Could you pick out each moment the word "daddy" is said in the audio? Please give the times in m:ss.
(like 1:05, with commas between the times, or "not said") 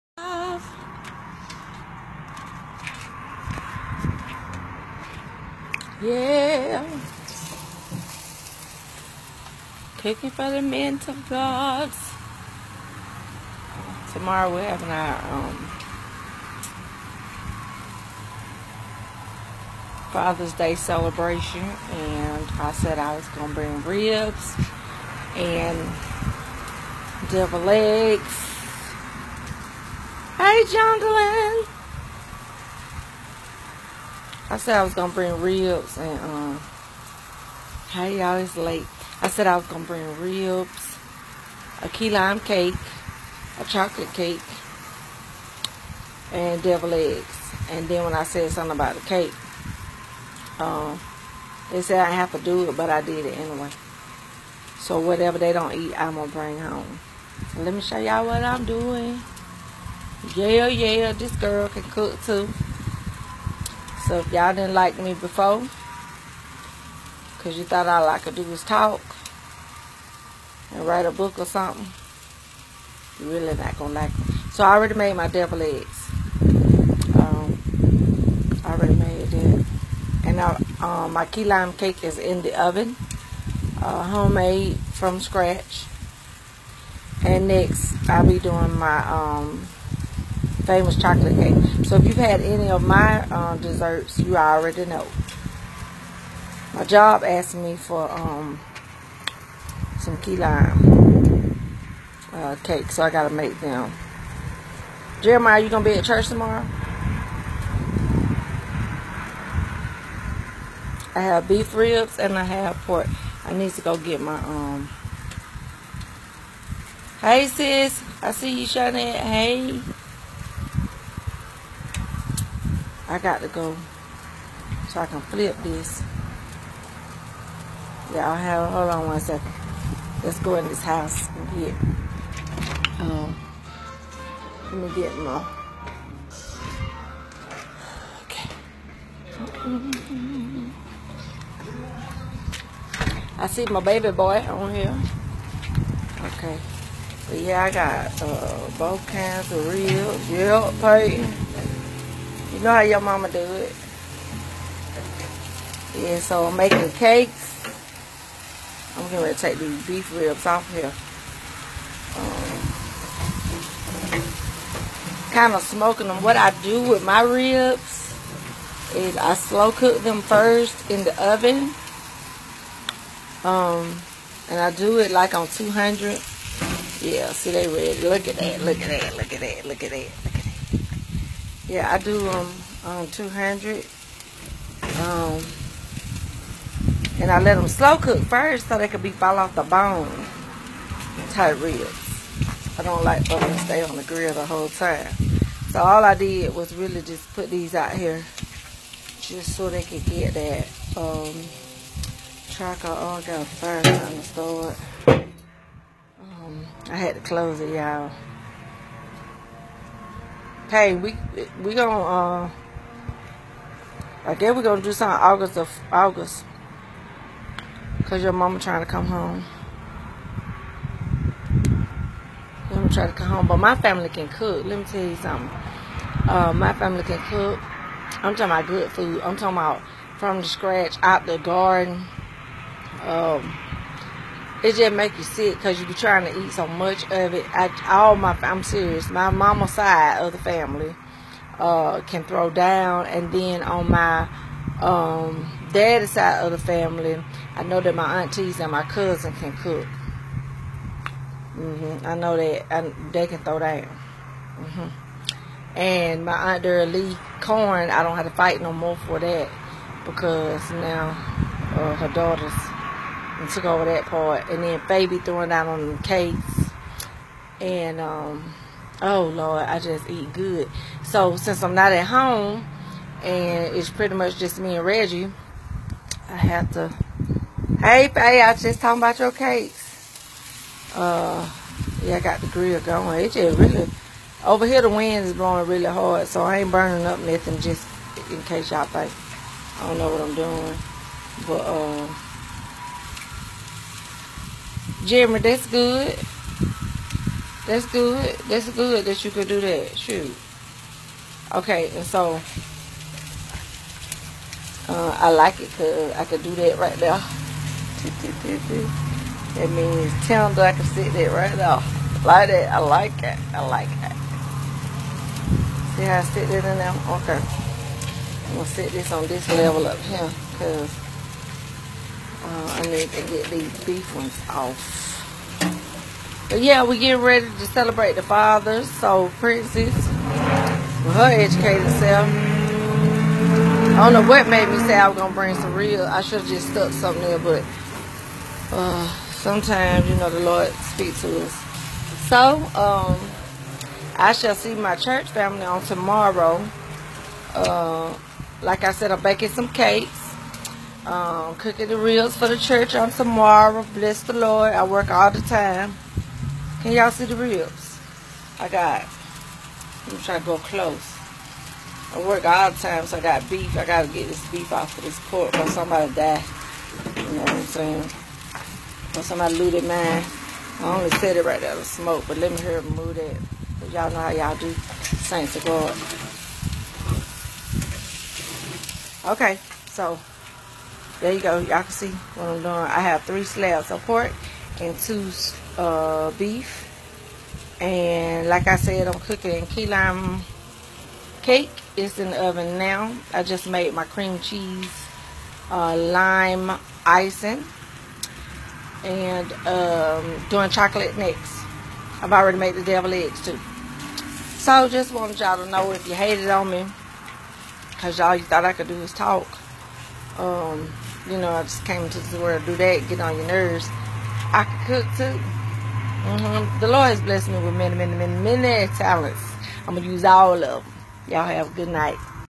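4:05.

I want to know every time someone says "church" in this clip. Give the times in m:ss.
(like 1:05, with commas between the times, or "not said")
1:46, 5:44, 5:52.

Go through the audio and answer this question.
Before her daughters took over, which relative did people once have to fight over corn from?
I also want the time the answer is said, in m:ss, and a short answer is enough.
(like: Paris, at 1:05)
Aunt Lee, at 4:16.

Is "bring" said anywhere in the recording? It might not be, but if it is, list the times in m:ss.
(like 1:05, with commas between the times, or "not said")
0:23, 0:35, 0:39, 0:56, 5:35.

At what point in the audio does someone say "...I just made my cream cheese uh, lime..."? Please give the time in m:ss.
6:33.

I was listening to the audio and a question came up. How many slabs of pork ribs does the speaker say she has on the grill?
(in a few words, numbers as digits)
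3.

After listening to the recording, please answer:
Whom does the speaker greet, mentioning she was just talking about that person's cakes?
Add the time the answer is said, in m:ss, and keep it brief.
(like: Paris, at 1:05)
Faye, at 4:38.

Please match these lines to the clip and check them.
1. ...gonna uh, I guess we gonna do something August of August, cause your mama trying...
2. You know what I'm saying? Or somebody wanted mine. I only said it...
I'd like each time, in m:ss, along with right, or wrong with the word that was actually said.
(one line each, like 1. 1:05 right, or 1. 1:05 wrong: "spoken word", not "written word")
1. 3:31 right
2. 6:07 wrong: "looted", not "wanted".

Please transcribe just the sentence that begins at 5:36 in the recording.
I should have just stuck something there, but uh, sometimes you know the Lord speaks to us.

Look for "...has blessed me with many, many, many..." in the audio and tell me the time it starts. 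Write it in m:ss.
6:57.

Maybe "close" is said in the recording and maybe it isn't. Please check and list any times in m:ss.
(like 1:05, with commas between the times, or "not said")
3:27, 6:00.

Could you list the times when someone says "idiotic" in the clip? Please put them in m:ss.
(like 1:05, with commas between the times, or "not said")
not said.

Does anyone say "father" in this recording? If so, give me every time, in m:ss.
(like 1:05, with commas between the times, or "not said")
0:20, 5:28.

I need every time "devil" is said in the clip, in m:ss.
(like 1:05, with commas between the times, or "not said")
0:27, 0:46, 1:15, 6:42.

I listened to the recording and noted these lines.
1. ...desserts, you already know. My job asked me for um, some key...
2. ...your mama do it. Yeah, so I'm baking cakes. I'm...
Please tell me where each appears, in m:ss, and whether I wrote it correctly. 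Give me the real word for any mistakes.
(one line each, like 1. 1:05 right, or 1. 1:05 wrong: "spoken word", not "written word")
1. 1:33 right
2. 2:32 wrong: "making", not "baking".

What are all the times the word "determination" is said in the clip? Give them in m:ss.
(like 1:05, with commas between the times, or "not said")
not said.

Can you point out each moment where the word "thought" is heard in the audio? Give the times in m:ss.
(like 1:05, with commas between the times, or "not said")
1:07, 6:48.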